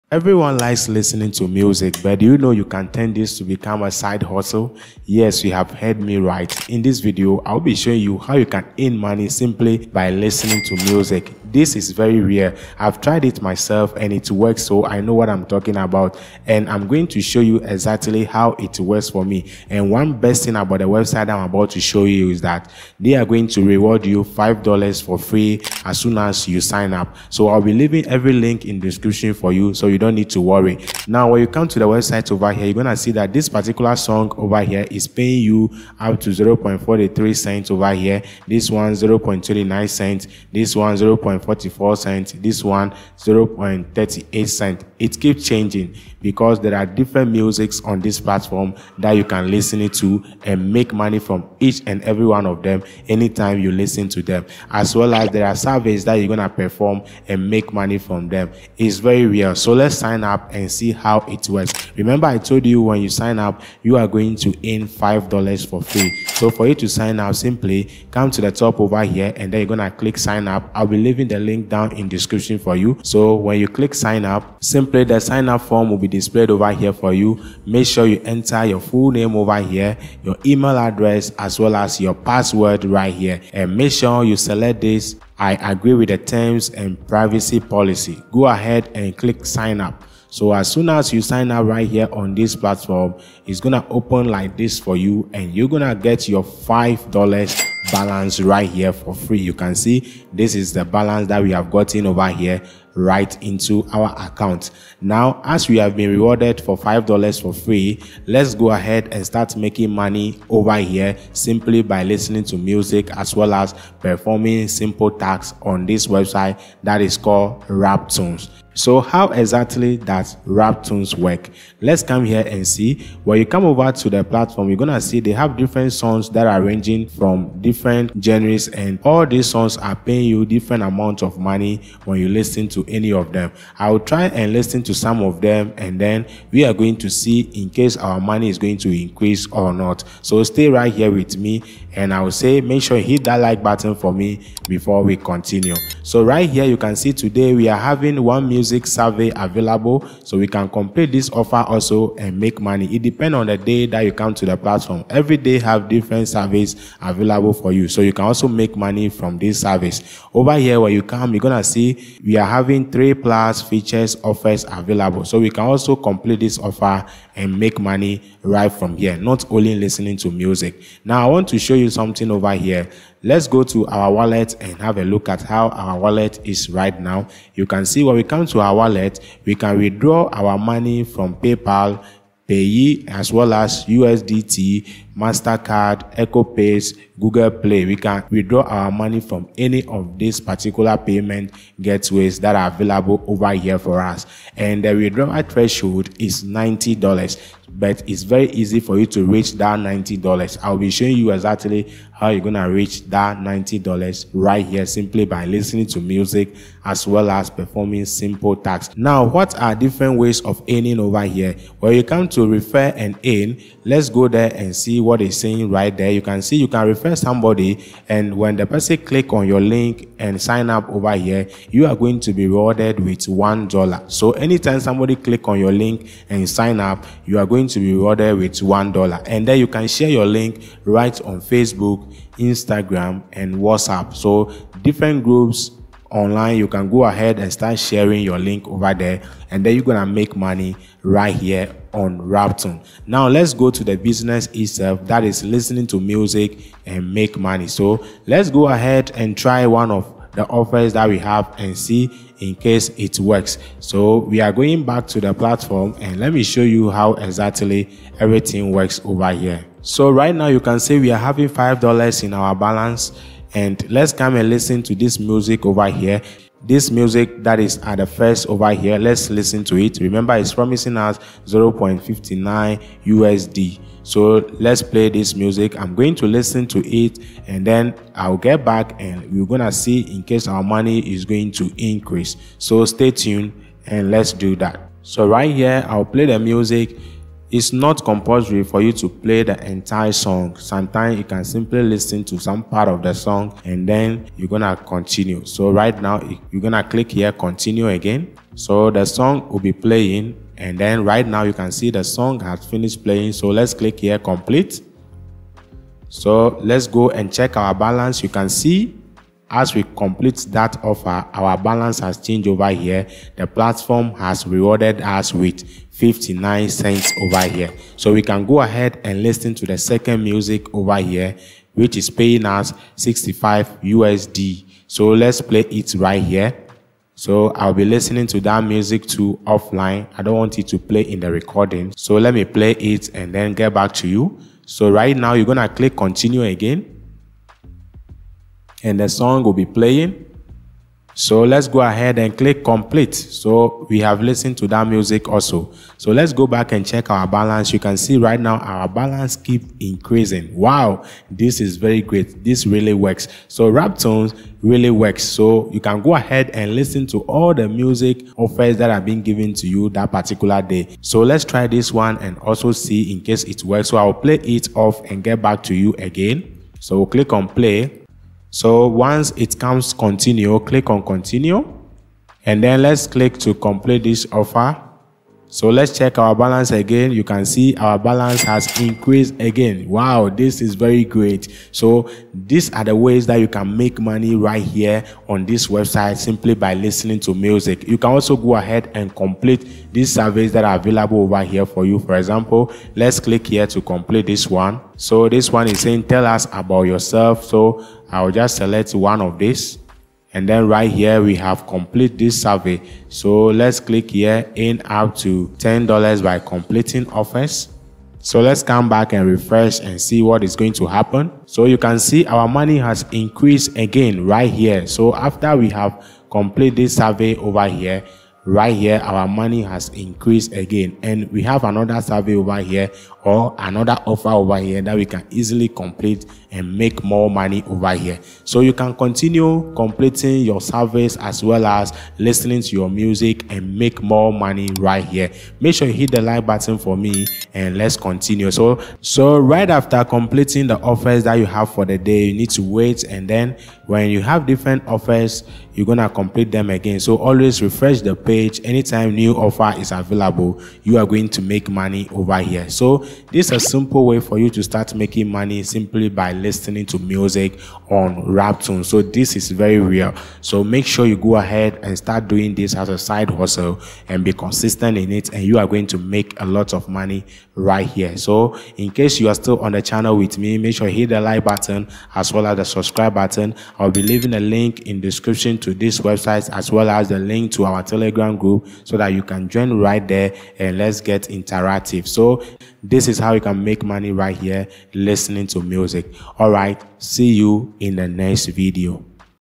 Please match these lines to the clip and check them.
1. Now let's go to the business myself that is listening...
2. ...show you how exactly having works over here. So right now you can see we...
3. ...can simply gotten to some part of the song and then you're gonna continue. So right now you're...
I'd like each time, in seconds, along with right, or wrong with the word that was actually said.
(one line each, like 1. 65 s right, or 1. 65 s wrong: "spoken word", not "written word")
1. 243 s wrong: "itself", not "myself"
2. 256 s wrong: "everything", not "having"
3. 291 s wrong: "listen", not "gotten".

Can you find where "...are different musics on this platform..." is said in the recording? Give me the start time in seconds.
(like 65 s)
46 s.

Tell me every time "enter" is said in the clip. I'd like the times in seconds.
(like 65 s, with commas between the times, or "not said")
78 s.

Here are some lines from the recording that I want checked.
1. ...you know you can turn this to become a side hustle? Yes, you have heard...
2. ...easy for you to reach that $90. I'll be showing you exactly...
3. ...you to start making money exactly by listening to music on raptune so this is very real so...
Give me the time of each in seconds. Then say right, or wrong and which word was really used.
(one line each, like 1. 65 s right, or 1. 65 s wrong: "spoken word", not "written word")
1. 2 s right
2. 198 s right
3. 454 s wrong: "simply", not "exactly".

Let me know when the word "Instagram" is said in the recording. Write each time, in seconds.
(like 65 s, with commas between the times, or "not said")
232 s.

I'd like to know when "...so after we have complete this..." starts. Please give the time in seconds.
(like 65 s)
414 s.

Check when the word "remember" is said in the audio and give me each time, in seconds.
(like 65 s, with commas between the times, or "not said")
61 s, 269 s.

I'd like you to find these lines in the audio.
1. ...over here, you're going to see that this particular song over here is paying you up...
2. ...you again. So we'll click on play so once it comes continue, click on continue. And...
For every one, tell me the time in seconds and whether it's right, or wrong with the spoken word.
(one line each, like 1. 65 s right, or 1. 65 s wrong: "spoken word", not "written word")
1. 32 s right
2. 365 s right.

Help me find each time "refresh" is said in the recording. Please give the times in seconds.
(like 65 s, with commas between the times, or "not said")
409 s, 447 s.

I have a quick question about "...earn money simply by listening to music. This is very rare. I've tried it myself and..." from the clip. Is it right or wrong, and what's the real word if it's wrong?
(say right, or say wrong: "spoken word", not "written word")
right.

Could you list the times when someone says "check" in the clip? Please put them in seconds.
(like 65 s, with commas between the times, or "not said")
307 s, 346 s, 375 s.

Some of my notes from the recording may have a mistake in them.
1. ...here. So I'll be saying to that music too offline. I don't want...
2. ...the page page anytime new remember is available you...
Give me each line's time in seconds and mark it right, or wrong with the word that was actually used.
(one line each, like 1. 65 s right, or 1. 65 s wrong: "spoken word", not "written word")
1. 326 s wrong: "listening", not "saying"
2. 448 s wrong: "offer", not "remember".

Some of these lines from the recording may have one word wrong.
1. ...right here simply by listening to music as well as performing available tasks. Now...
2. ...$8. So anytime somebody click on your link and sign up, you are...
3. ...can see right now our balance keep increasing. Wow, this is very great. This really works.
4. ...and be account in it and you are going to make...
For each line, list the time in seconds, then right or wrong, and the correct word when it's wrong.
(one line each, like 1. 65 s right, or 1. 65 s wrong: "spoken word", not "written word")
1. 204 s wrong: "simple", not "available"
2. 223 s wrong: "1", not "8"
3. 347 s right
4. 464 s wrong: "consistent", not "account".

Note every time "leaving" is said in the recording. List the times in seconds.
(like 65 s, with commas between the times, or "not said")
27 s, 70 s, 474 s.